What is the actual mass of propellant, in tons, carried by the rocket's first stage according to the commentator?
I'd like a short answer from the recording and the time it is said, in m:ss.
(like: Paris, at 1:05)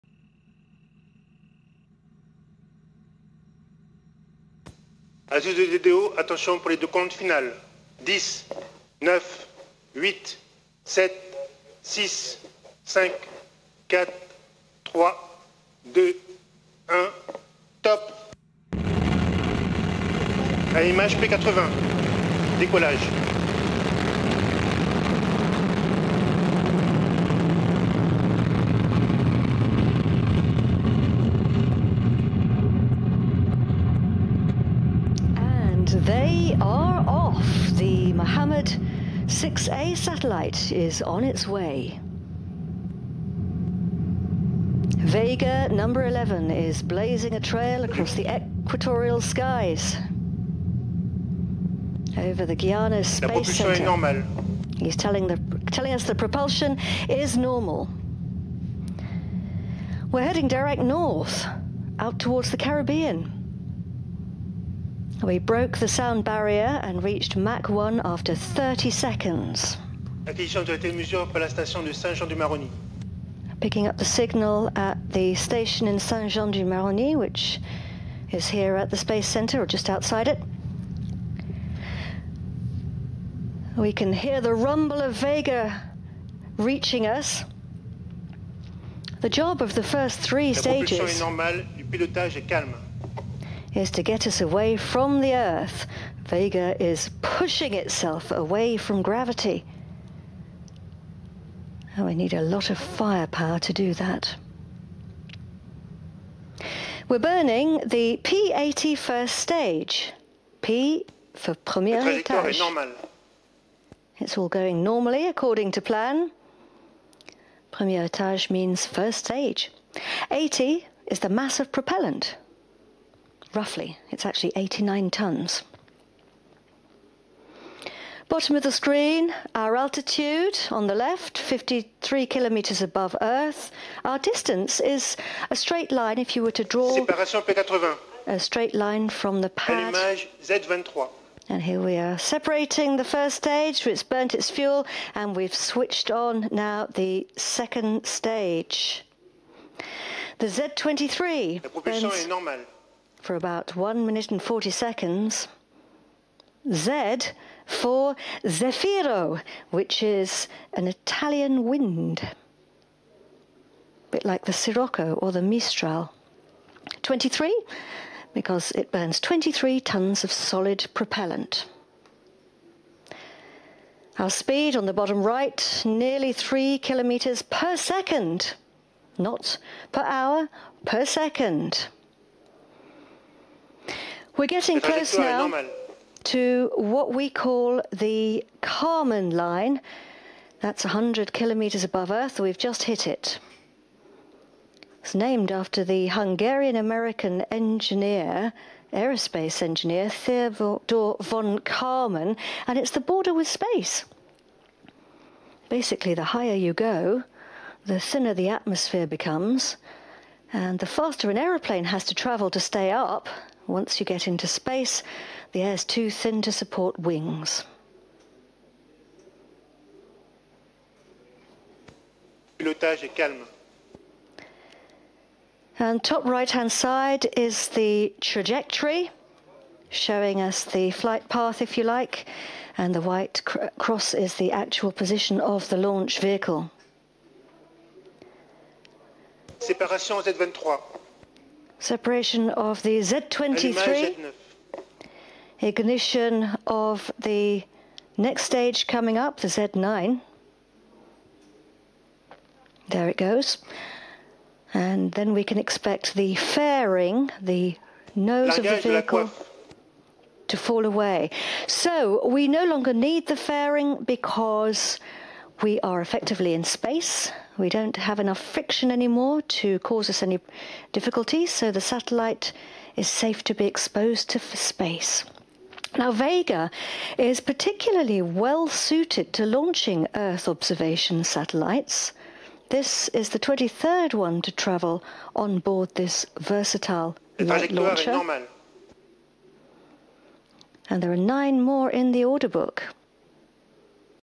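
89 tons, at 2:04.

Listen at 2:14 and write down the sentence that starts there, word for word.
Our distance is a straight line if you were to draw a straight line from the pad.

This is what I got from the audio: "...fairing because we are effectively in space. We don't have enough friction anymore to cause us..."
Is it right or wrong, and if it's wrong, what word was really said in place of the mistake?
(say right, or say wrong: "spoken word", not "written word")
right.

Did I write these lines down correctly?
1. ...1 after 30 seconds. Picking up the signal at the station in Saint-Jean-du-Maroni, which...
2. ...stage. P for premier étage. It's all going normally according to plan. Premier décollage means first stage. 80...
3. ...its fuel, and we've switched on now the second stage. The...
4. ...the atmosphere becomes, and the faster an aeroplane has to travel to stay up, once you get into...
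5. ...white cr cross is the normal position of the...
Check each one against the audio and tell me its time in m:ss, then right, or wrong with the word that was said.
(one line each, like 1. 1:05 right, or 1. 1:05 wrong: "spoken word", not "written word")
1. 1:07 right
2. 1:49 wrong: "étage", not "décollage"
3. 2:24 right
4. 3:28 right
5. 3:53 wrong: "actual", not "normal".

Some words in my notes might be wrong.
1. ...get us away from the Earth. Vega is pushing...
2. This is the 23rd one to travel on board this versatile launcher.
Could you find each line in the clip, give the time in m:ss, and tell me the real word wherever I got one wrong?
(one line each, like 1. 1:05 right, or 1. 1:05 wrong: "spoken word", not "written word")
1. 1:34 right
2. 4:42 right.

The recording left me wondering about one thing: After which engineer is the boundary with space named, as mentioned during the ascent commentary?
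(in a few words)
Theodor von Kármán.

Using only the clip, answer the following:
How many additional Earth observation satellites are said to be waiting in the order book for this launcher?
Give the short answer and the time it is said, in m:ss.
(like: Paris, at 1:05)
9, at 4:51.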